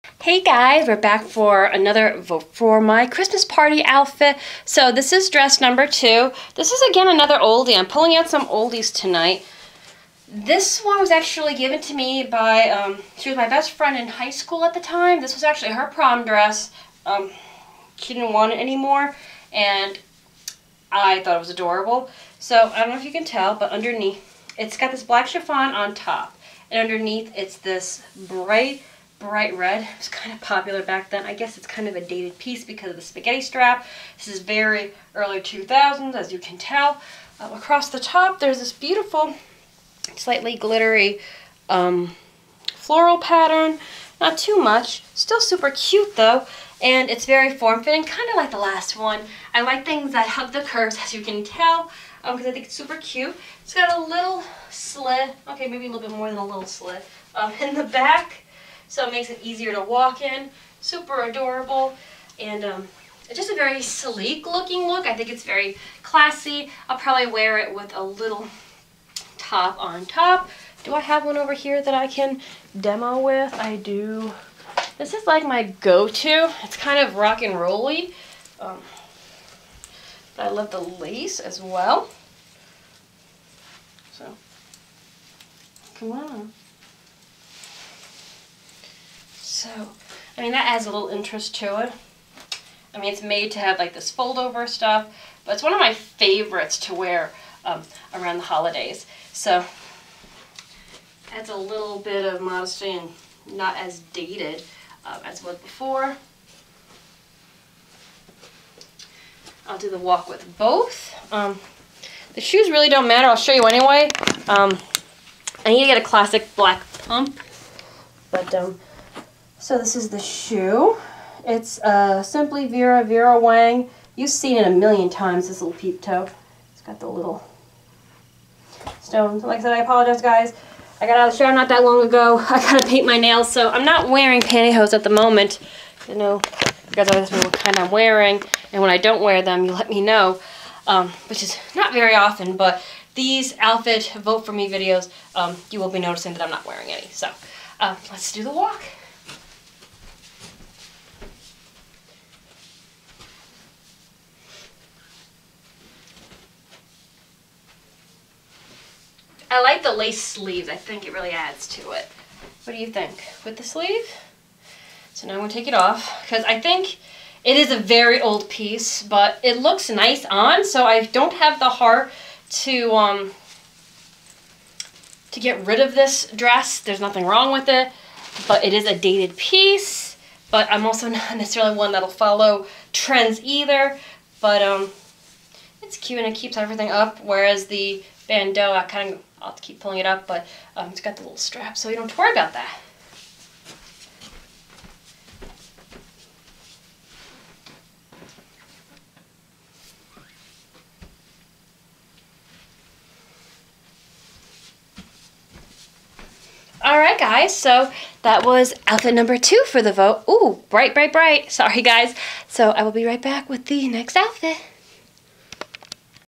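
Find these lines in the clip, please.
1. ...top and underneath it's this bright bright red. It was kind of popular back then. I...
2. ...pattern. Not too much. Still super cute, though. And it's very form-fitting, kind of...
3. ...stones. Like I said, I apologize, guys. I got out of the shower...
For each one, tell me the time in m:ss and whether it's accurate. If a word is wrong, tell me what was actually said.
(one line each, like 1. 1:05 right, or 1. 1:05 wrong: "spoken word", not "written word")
1. 0:25 right
2. 0:43 right
3. 2:09 right.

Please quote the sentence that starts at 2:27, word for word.
So um, let's do the walk.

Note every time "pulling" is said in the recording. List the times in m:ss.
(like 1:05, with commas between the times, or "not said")
0:07, 3:09.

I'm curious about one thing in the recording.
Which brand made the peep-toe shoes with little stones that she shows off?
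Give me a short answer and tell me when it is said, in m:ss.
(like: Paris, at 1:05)
Simply Vera, Vera Wang, at 2:02.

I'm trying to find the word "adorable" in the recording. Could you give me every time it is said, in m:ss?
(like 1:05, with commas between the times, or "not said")
0:21, 1:01.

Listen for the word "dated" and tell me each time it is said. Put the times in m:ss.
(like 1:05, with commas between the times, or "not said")
0:32, 1:44, 2:58.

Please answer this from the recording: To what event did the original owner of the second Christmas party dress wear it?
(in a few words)
Prom.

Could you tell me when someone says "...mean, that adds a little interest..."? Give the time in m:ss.
1:30.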